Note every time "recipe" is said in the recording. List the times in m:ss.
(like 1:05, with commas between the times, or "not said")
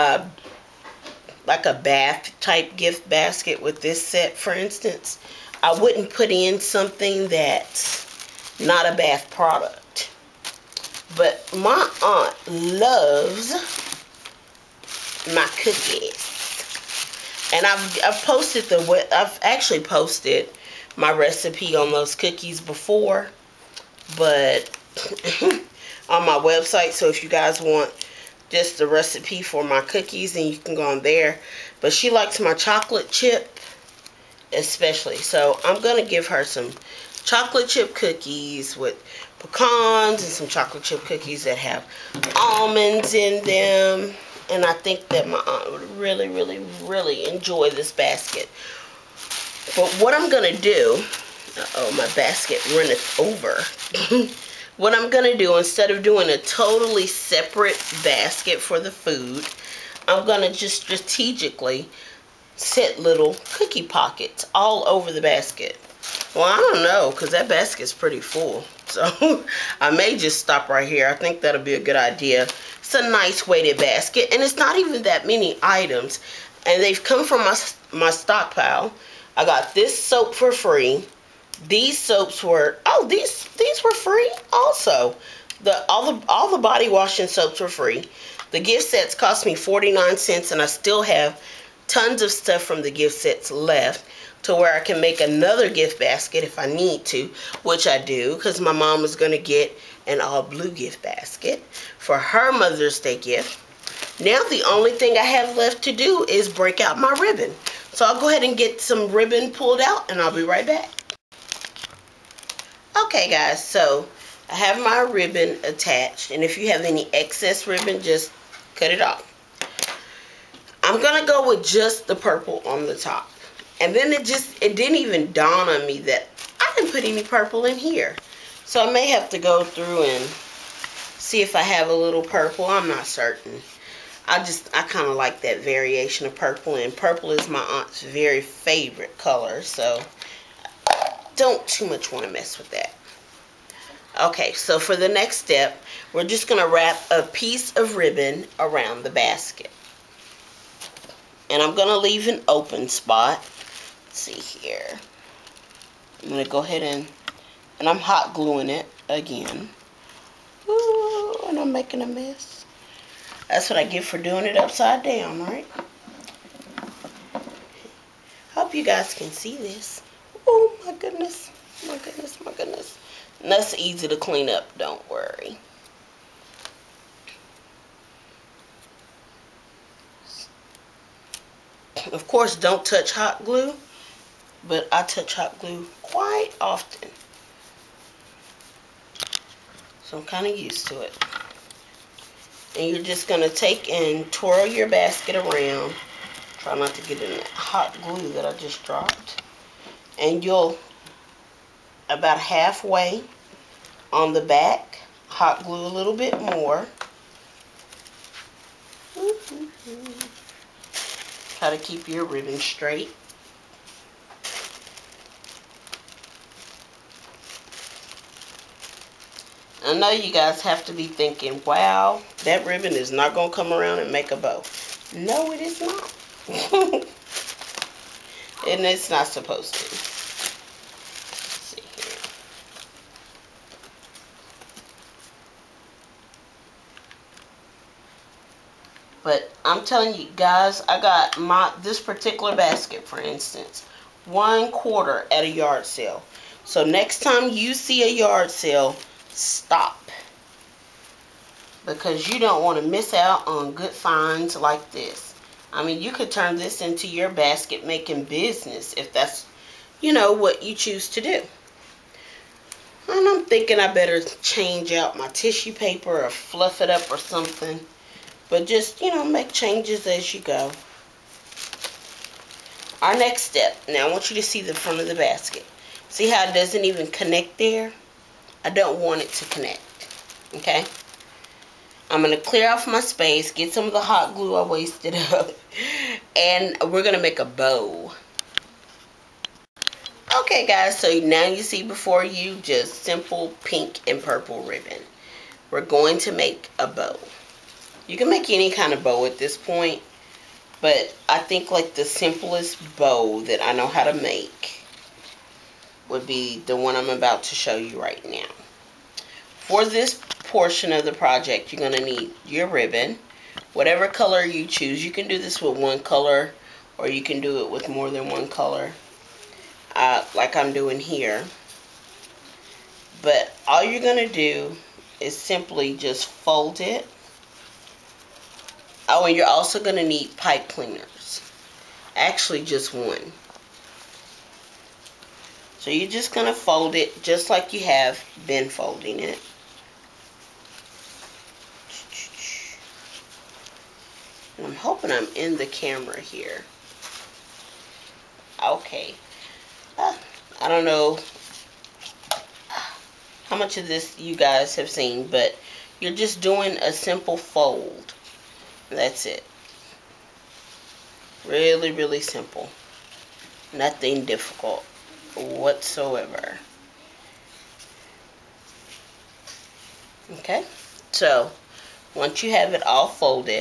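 0:21, 0:28.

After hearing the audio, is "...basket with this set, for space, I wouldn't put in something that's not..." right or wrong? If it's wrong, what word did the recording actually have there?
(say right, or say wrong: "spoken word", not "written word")
wrong: "instance", not "space".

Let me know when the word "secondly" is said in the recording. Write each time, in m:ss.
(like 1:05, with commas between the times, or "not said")
not said.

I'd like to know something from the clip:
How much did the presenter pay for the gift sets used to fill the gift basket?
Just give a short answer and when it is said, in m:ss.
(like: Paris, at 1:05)
49 cents, at 1:29.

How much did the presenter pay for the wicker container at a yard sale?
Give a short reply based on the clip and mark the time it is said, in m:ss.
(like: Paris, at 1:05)
One quarter, at 4:04.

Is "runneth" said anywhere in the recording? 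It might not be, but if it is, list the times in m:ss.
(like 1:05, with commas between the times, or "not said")
0:52.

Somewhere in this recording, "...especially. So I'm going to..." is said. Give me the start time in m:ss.
0:34.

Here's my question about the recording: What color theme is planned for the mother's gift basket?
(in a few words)
Blue.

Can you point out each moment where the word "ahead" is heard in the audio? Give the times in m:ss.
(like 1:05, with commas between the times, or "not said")
1:48, 2:36.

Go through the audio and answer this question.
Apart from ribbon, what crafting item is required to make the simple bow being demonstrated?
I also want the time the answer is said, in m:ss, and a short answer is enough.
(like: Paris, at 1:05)
Pipe cleaners, at 5:30.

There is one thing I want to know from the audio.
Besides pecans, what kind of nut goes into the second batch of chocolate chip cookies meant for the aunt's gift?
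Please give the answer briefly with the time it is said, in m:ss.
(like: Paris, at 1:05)
Almonds, at 0:42.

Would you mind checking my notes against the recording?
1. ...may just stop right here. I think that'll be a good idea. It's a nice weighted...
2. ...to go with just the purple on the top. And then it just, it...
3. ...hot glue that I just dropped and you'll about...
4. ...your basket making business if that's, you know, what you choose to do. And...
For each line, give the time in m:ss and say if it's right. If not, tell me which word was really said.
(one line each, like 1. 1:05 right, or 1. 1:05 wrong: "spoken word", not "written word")
1. 1:09 right
2. 2:01 right
3. 3:17 right
4. 4:17 right.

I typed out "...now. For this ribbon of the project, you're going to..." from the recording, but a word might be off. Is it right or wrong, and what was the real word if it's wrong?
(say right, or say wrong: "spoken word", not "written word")
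wrong: "portion", not "ribbon".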